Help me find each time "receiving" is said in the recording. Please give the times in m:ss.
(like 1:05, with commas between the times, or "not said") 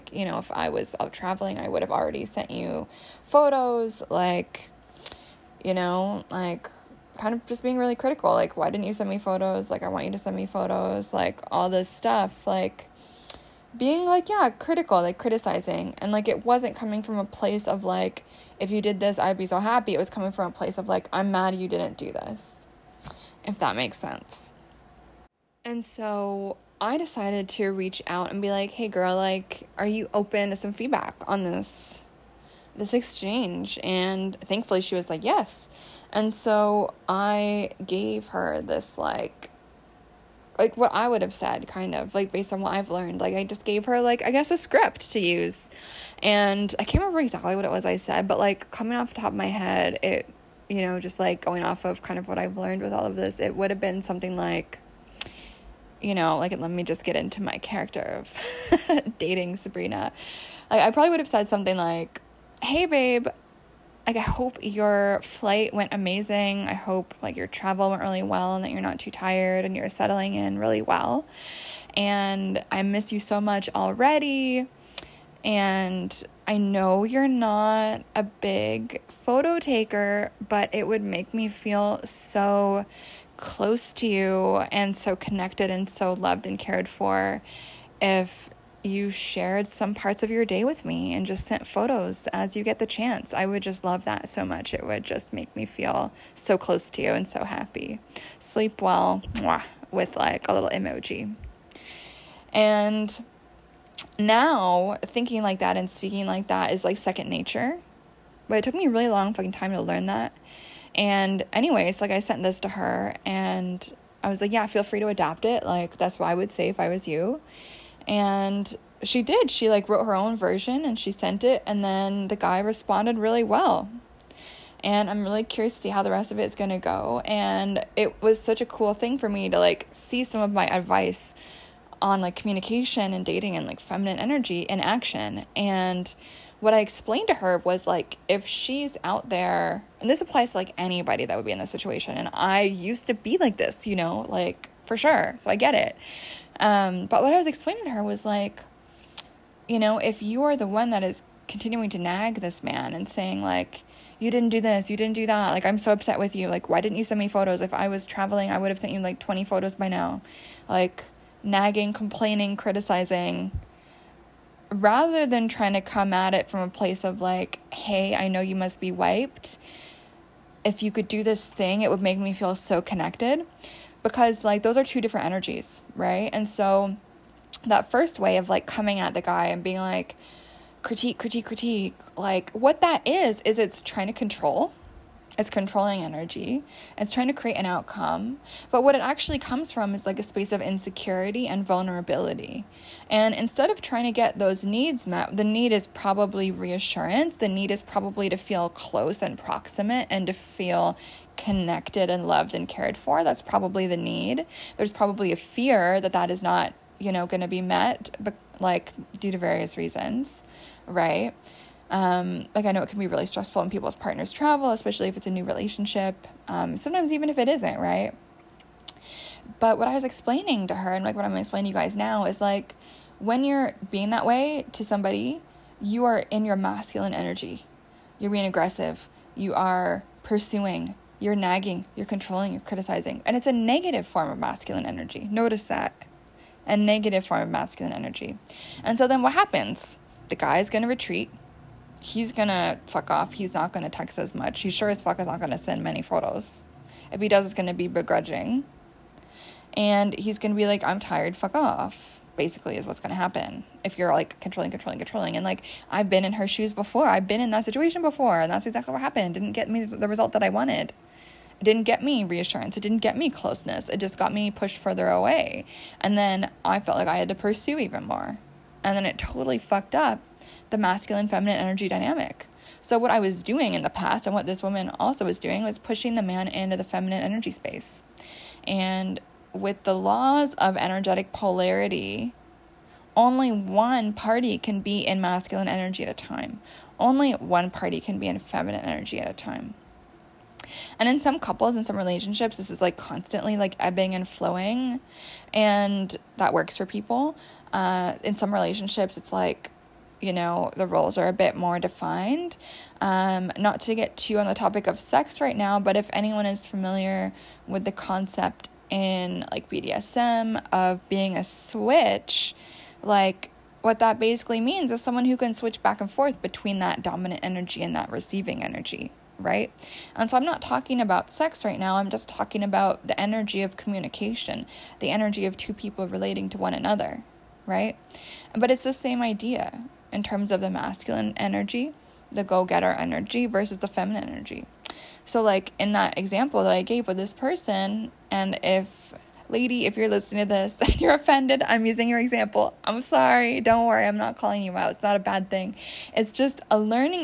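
5:18.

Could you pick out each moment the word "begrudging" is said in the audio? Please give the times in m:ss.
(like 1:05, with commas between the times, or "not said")
4:07.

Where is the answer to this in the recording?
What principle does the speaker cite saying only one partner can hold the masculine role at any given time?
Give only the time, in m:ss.
4:39.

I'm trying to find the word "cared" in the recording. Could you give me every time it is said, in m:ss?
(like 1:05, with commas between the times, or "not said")
1:26, 3:22.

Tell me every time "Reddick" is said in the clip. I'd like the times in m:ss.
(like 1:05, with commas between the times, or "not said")
not said.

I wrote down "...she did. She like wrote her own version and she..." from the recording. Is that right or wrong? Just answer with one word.
right.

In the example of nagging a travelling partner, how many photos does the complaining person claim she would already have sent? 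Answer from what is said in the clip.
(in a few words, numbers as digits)
20.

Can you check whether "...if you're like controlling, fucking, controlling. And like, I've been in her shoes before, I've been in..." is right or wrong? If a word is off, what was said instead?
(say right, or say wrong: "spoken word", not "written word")
wrong: "controlling", not "fucking".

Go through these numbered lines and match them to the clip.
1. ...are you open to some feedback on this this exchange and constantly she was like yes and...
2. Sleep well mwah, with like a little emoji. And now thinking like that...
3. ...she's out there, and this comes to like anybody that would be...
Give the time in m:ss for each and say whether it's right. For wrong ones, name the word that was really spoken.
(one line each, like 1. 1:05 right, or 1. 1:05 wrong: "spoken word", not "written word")
1. 0:29 wrong: "thankfully", not "constantly"
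2. 1:38 right
3. 2:18 wrong: "applies", not "comes".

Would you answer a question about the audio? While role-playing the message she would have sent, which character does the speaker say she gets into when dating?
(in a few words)
Sabrina.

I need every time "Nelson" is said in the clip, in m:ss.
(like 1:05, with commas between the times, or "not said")
not said.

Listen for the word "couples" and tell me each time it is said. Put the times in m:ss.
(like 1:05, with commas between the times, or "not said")
4:51.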